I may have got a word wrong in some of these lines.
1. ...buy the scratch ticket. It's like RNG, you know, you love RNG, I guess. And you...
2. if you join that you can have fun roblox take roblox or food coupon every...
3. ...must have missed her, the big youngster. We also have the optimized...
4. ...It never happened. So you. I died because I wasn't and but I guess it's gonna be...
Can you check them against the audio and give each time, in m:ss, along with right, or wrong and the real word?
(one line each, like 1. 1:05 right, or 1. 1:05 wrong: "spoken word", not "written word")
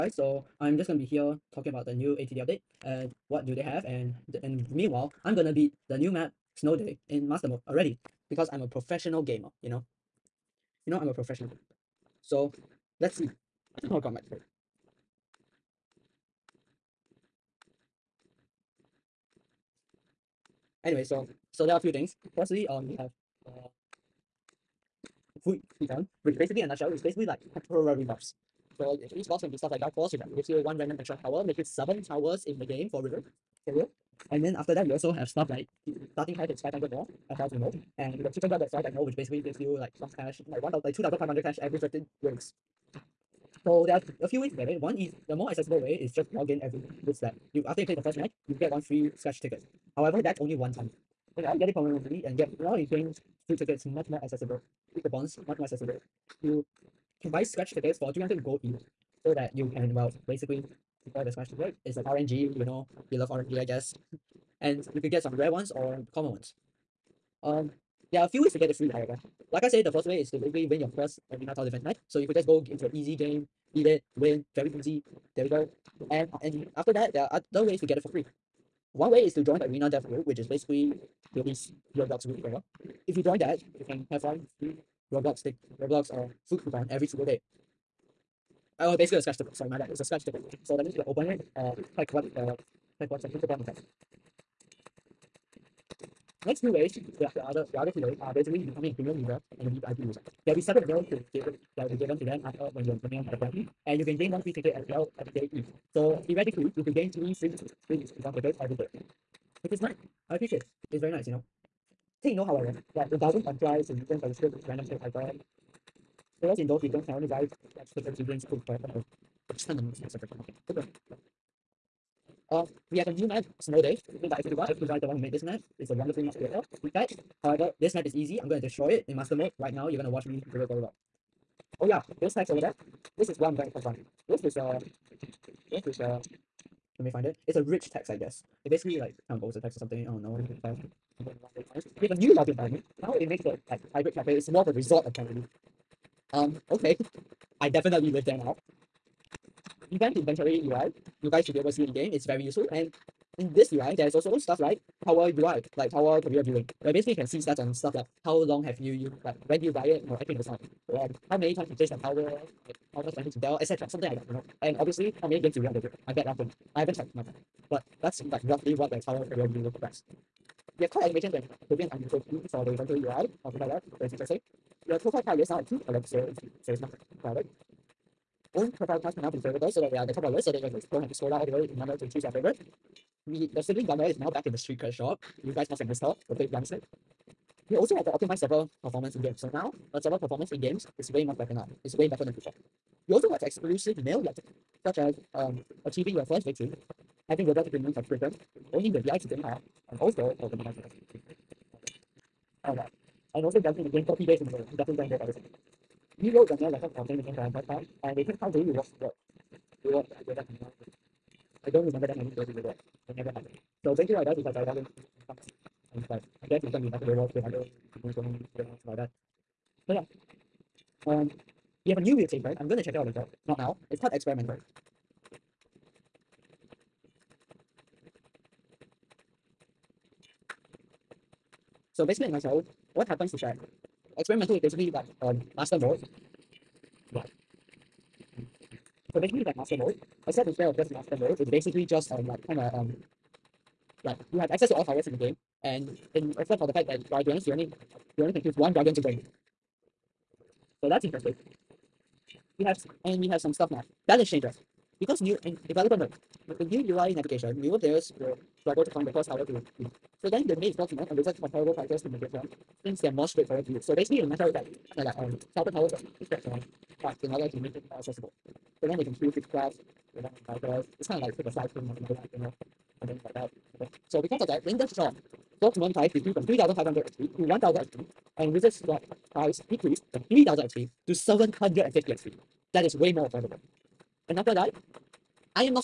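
1. 1:01 right
2. 1:23 right
3. 3:05 right
4. 3:33 right.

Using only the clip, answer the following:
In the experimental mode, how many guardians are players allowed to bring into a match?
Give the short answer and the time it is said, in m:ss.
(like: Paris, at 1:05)
1, at 4:08.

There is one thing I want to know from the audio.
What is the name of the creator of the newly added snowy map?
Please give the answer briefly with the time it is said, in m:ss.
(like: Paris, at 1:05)
F2, at 2:04.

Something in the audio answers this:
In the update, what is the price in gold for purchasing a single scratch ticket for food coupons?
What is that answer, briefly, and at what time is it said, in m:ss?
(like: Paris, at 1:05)
300 gold, at 0:58.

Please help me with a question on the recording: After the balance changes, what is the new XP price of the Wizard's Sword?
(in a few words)
750 XP.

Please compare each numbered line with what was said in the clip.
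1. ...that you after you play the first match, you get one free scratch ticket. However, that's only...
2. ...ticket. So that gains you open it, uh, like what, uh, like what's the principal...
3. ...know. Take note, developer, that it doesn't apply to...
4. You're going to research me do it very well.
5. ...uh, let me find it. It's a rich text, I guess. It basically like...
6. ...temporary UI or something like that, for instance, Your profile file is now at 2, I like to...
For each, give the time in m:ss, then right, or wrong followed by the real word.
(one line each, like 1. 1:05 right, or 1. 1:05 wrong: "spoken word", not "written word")
1. 0:47 right
2. 1:30 wrong: "means", not "gains"
3. 1:51 wrong: "however", not "developer"
4. 2:09 wrong: "watch", not "research"
5. 2:15 right
6. 2:52 right.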